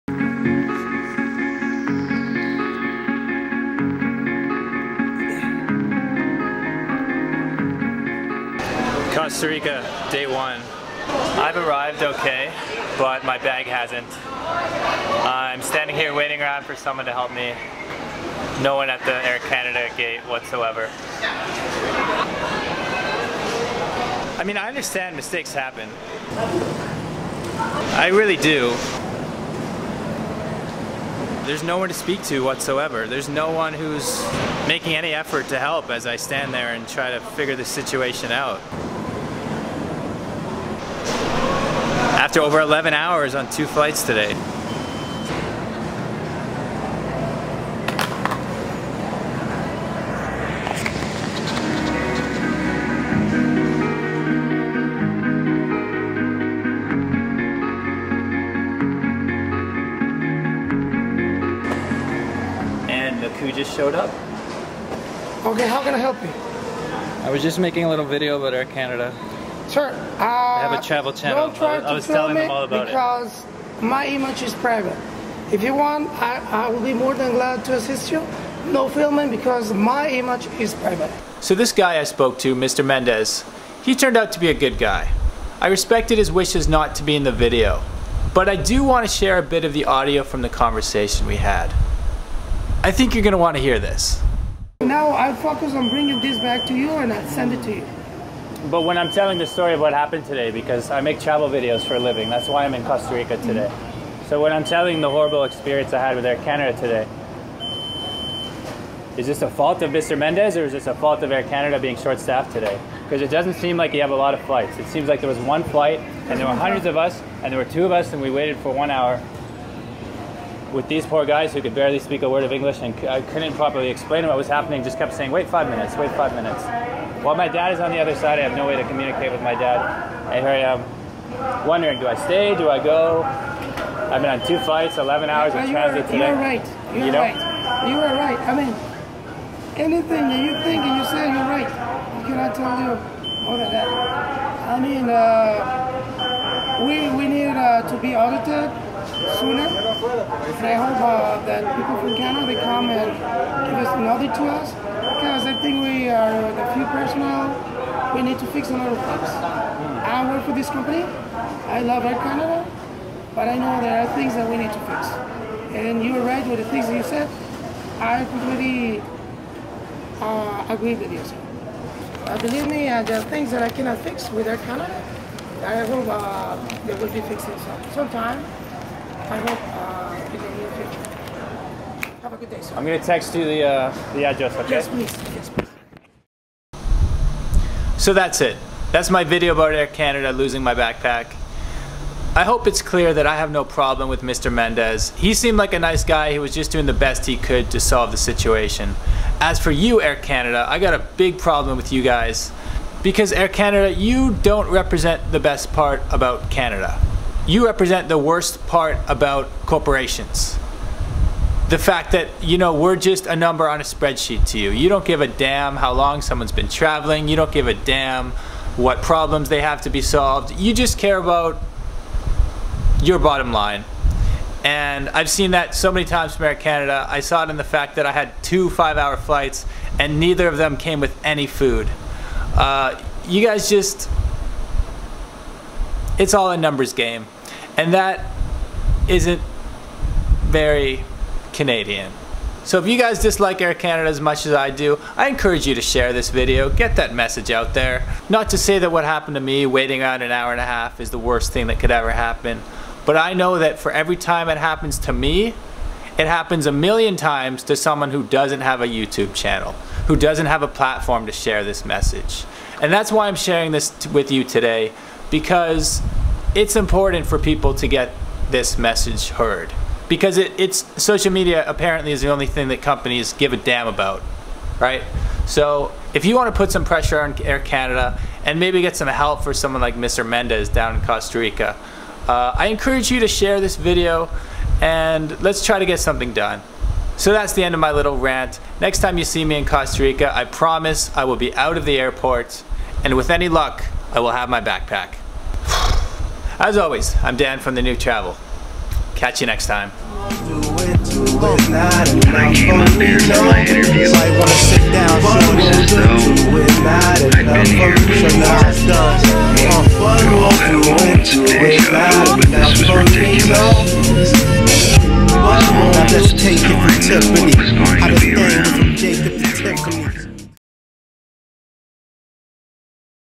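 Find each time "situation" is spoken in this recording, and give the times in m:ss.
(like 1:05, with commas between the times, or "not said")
0:37, 3:18.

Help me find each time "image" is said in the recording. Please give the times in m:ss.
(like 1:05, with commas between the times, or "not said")
1:14, 1:20.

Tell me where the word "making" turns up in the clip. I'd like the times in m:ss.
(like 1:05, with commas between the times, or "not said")
0:34, 1:07.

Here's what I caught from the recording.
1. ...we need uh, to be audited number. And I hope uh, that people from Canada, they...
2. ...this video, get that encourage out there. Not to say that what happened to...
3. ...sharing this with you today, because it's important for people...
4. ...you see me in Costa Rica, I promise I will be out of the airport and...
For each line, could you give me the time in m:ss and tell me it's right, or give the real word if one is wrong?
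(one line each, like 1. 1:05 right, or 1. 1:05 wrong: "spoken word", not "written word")
1. 2:27 wrong: "sooner", not "number"
2. 4:06 wrong: "message", not "encourage"
3. 4:23 right
4. 4:49 right.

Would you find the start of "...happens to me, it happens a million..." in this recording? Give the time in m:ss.
4:14.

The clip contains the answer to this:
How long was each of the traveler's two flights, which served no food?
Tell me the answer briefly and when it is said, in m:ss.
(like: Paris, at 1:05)
5 hours, at 3:48.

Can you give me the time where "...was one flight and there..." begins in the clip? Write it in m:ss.
1:55.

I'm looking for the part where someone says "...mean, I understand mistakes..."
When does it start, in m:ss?
0:24.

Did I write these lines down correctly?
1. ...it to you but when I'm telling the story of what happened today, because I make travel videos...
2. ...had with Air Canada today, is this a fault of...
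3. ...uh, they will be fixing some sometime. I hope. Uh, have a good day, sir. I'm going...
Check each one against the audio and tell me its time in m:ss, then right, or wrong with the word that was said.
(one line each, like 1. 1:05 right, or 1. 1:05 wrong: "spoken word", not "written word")
1. 1:37 right
2. 1:45 right
3. 2:56 right.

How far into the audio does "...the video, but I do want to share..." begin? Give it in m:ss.
1:27.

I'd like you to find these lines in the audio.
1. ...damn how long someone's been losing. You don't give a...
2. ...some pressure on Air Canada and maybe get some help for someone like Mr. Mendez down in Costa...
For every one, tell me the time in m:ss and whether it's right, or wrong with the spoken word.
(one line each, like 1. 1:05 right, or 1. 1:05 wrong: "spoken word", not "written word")
1. 3:35 wrong: "traveling", not "losing"
2. 4:36 right.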